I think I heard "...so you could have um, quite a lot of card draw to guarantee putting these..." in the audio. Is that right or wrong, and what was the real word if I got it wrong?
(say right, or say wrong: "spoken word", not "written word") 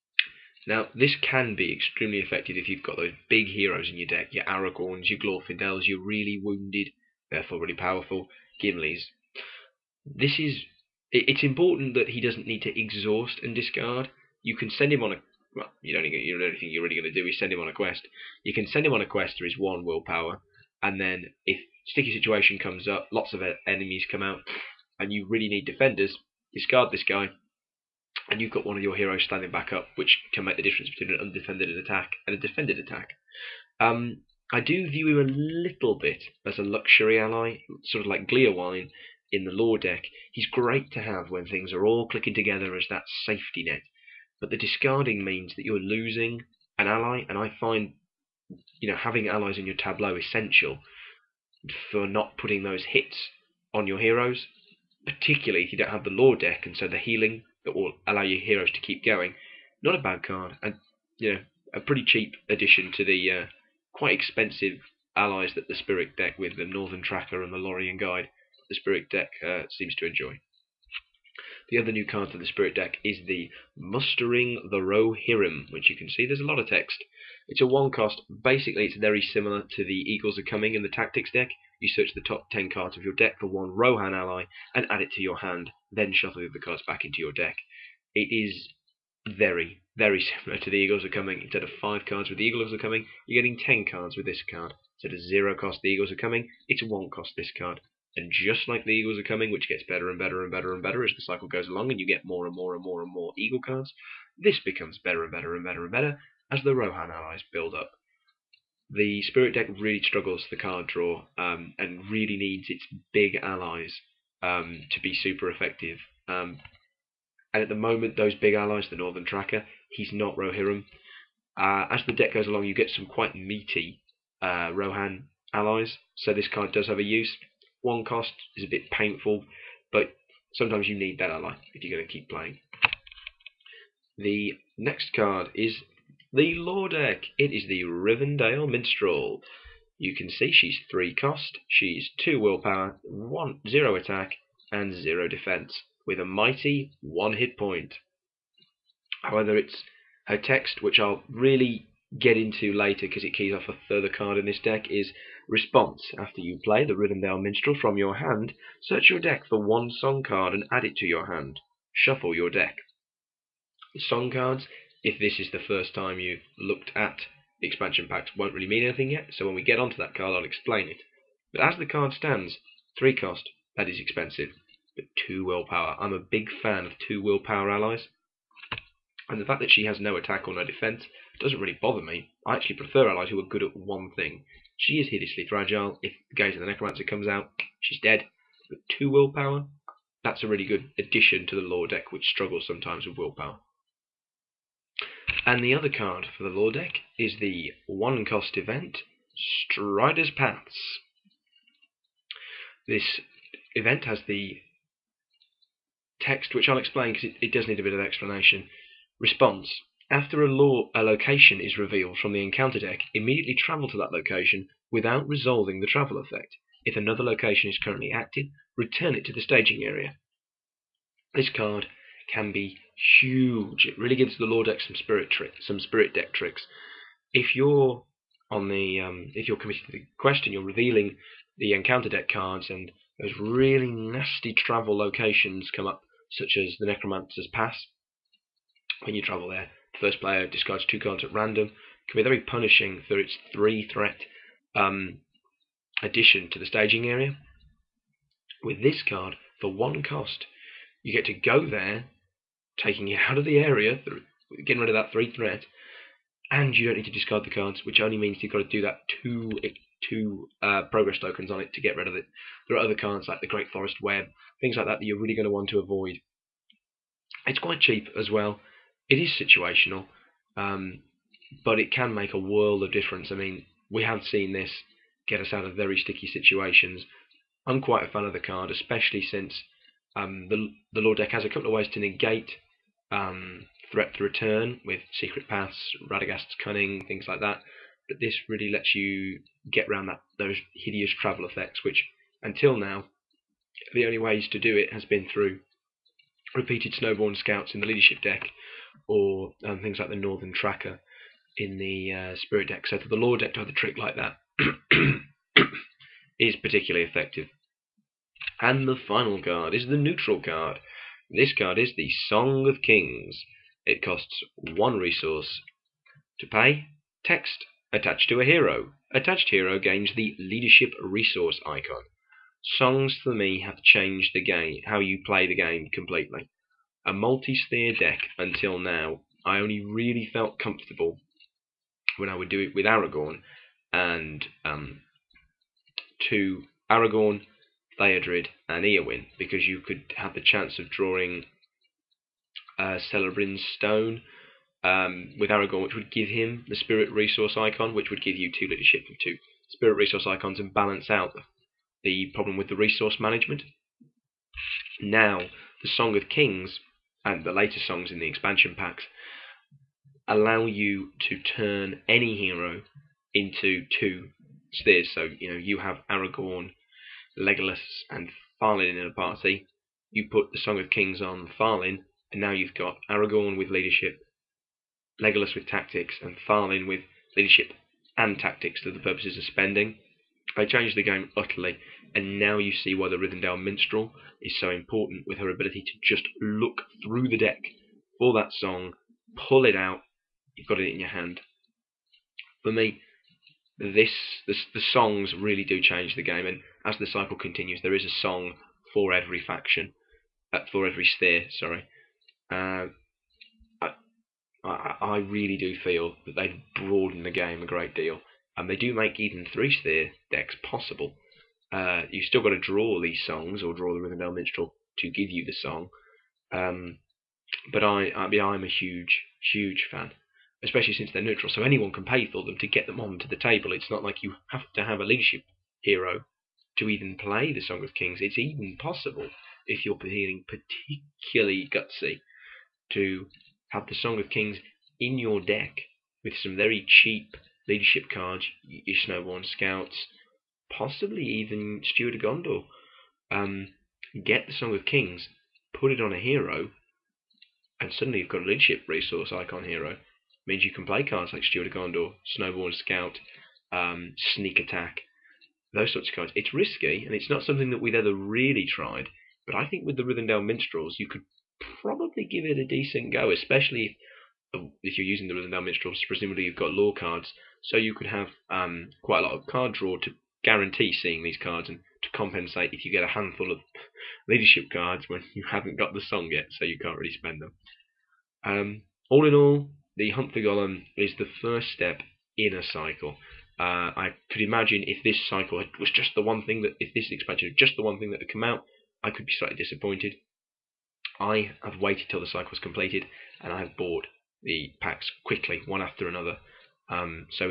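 wrong: "seeing", not "putting".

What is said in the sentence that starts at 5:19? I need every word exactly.
Attached hero gains the leadership resource icon.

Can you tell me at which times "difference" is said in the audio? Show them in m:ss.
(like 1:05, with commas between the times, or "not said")
0:30, 4:32.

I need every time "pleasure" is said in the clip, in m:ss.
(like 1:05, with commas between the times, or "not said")
not said.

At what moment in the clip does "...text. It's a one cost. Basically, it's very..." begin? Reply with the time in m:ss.
1:16.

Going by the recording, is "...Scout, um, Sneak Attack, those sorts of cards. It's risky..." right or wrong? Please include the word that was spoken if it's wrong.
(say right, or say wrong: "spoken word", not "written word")
right.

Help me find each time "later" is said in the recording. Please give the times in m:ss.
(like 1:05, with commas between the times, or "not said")
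2:32, 5:57.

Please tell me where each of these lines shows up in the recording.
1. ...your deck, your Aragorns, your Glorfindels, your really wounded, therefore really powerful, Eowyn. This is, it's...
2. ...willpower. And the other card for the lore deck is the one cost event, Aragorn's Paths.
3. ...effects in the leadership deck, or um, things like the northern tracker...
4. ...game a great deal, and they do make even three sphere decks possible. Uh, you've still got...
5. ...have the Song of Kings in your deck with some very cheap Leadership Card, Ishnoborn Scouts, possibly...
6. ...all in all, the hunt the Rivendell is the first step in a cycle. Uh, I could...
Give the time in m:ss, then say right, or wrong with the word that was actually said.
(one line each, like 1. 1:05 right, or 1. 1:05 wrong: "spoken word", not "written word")
1. 0:03 wrong: "Gimlis", not "Eowyn"
2. 3:13 wrong: "Strider", not "Aragorn"
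3. 4:57 wrong: "scouts", not "effects"
4. 6:47 right
5. 7:13 right
6. 7:59 wrong: "Gollum", not "Rivendell".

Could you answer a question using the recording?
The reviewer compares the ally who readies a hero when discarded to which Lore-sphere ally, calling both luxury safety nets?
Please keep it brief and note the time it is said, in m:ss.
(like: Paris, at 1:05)
Gleowine, at 0:38.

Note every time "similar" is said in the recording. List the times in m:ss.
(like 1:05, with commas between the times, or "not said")
1:19, 1:30.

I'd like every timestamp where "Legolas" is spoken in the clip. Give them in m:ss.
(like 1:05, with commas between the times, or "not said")
6:07, 6:15.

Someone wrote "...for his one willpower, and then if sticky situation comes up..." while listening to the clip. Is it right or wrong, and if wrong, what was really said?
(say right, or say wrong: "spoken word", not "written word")
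right.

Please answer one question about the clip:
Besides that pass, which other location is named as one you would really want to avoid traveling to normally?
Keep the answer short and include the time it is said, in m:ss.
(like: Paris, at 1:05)
Great Forest Web, at 4:23.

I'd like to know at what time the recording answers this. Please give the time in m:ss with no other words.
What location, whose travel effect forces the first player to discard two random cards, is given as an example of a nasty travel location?
3:56.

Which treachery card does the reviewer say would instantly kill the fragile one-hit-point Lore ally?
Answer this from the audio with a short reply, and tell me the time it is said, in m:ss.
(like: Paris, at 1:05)
Gaze of the Necromancer, at 3:06.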